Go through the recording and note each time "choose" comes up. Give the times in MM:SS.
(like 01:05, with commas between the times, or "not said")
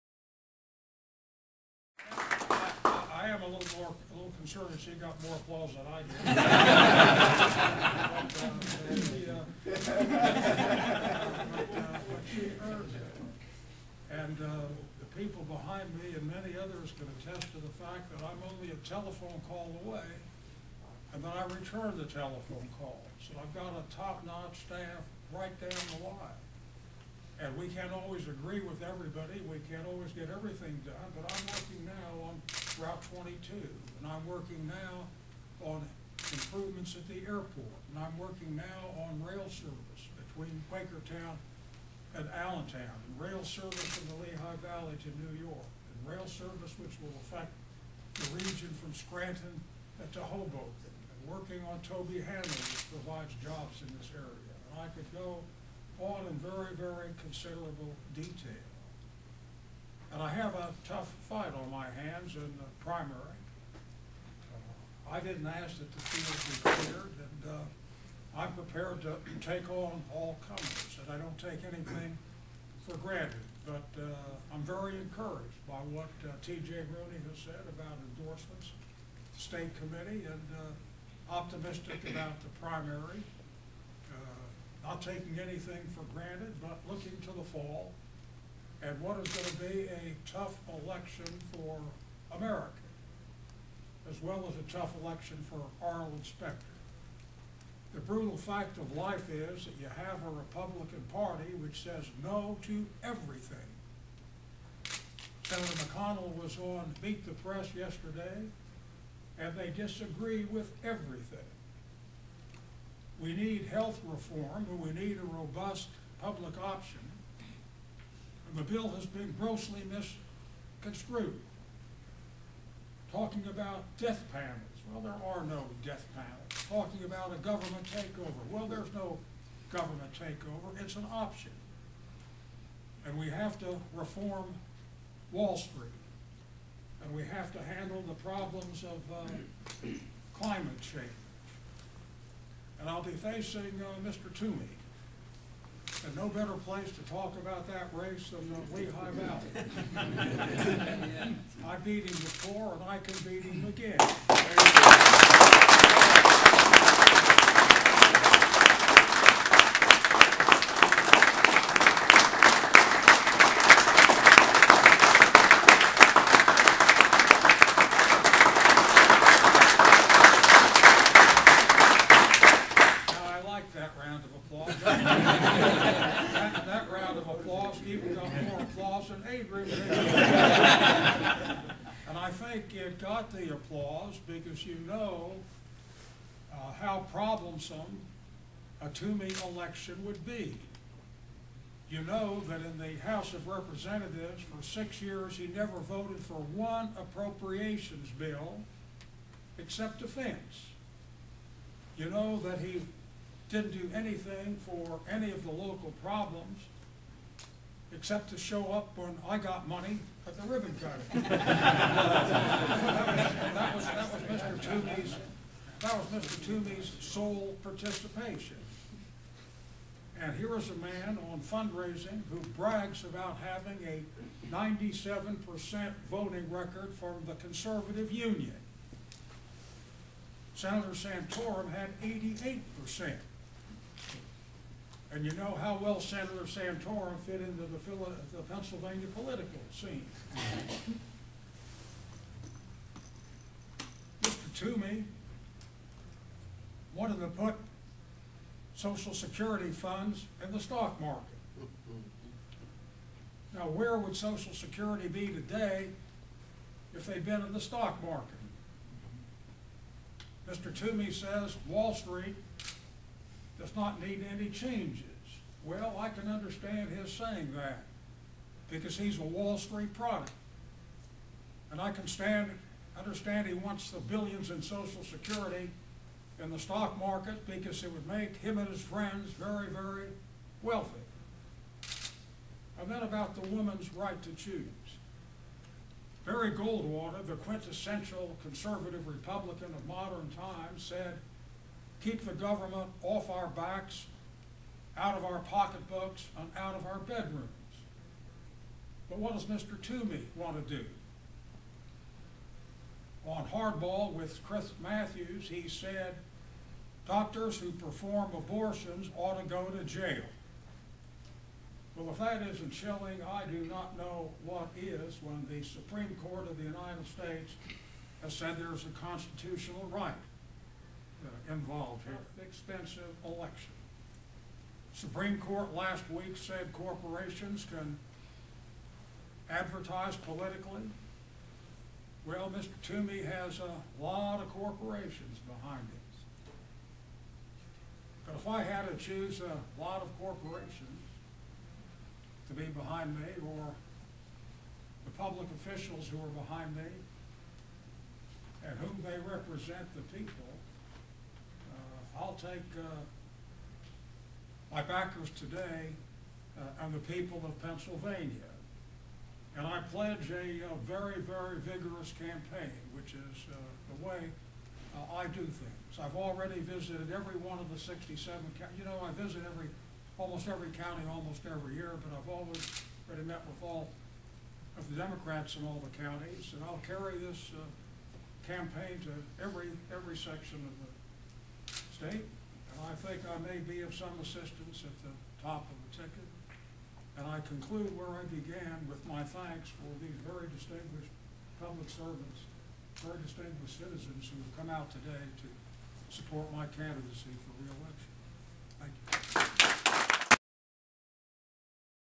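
04:44, 05:39.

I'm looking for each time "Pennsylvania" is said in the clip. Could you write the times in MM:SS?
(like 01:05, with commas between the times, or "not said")
03:58, 05:57.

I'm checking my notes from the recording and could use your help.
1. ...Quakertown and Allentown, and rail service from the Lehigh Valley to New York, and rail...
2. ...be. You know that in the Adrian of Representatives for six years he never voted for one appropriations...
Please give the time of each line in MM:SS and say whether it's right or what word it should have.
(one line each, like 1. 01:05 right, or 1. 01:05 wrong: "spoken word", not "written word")
1. 00:40 right
2. 03:10 wrong: "House", not "Adrian".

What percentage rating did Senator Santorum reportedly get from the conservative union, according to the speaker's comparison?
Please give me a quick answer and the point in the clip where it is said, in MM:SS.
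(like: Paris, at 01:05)
88%, at 03:52.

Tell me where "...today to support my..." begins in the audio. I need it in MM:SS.
06:34.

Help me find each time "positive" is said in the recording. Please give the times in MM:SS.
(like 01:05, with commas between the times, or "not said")
not said.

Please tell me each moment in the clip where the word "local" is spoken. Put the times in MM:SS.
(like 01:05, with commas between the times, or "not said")
03:25.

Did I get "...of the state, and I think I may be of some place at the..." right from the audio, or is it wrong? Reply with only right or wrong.
wrong.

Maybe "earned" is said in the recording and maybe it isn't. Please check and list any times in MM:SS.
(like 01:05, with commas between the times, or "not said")
00:12.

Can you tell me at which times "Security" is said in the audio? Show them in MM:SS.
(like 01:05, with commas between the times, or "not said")
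04:09, 04:14, 04:35.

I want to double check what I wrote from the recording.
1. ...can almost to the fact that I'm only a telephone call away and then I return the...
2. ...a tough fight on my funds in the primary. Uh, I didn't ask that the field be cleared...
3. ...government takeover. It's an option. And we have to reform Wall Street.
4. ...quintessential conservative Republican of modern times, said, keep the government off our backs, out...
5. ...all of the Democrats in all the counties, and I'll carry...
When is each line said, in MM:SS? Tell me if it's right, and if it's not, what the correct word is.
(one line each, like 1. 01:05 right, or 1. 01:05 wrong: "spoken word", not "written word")
1. 00:16 wrong: "attest", not "almost"
2. 01:00 wrong: "hands", not "funds"
3. 02:09 right
4. 04:47 right
5. 06:13 right.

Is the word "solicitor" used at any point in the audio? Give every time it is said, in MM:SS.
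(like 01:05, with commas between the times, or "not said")
not said.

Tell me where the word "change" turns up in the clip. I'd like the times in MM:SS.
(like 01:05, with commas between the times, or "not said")
02:20, 04:24.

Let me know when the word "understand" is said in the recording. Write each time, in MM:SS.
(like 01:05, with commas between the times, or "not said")
04:26, 04:32.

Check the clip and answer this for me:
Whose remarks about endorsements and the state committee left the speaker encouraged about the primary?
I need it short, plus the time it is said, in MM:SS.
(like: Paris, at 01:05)
T.J. Rooney, at 01:16.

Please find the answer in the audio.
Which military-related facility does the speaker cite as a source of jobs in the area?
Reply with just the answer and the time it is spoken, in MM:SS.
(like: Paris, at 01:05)
Tobyhanna, at 00:51.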